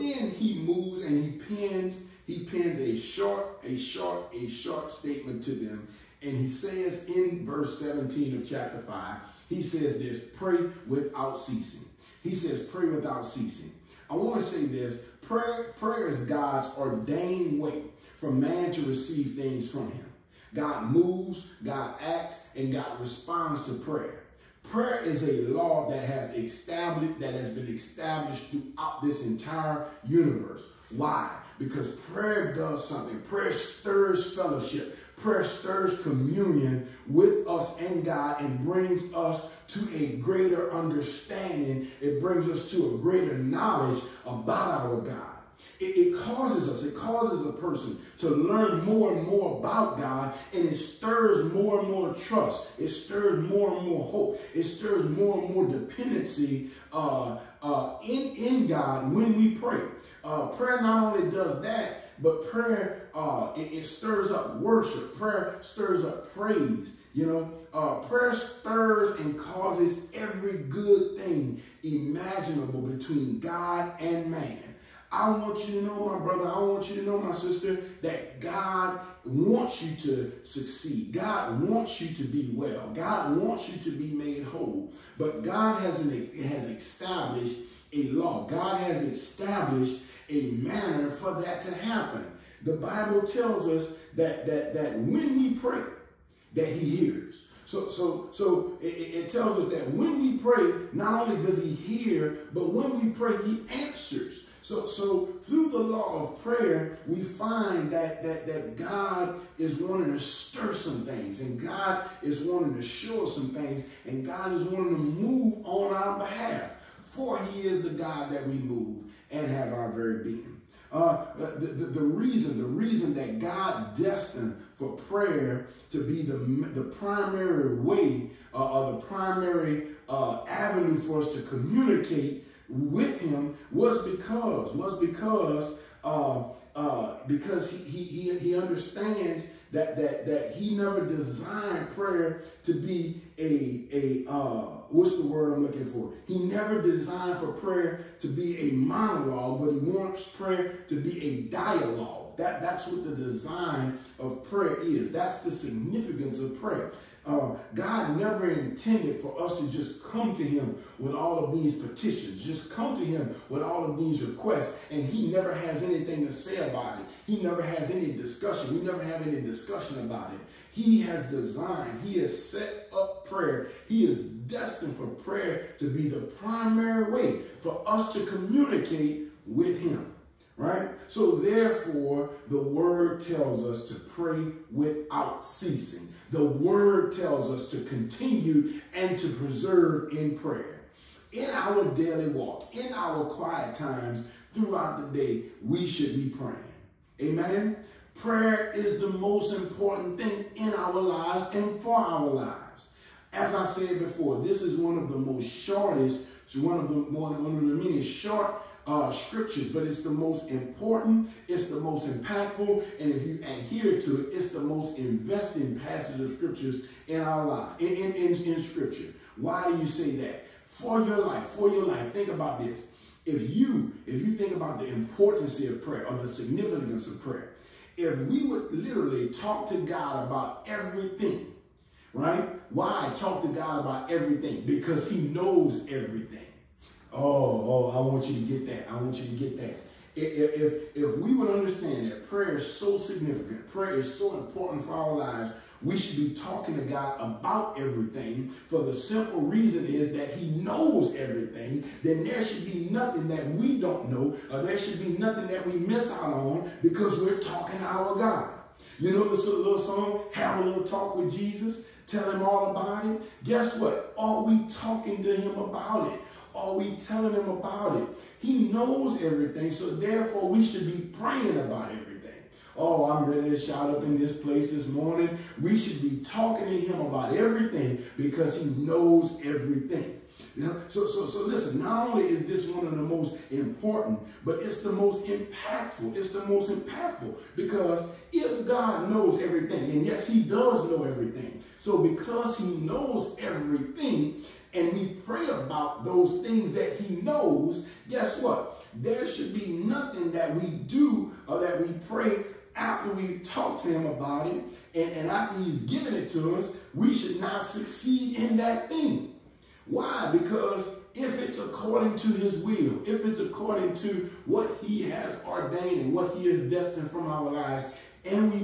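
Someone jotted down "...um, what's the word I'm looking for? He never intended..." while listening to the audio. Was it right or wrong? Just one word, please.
wrong.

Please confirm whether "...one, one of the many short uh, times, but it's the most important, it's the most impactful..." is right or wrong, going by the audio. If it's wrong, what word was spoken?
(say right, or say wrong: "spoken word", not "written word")
wrong: "scriptures", not "times".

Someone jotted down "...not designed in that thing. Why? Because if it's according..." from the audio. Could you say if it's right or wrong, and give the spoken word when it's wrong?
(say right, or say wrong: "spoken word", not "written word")
wrong: "succeed", not "designed".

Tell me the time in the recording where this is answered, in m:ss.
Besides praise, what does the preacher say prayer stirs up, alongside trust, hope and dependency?
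1:04.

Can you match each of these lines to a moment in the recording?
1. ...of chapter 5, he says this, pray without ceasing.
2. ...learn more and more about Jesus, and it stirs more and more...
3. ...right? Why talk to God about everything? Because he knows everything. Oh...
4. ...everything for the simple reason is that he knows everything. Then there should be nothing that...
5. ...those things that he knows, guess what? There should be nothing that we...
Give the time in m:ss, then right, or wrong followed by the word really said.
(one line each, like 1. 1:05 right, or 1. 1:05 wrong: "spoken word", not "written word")
1. 0:08 right
2. 0:48 wrong: "God", not "Jesus"
3. 3:52 right
4. 4:07 right
5. 4:56 right.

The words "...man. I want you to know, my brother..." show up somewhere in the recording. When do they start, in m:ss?
1:14.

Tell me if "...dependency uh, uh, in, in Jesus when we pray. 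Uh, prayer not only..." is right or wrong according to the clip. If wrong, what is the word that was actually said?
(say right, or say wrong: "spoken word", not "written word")
wrong: "God", not "Jesus".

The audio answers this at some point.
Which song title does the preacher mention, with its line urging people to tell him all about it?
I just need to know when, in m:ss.
4:20.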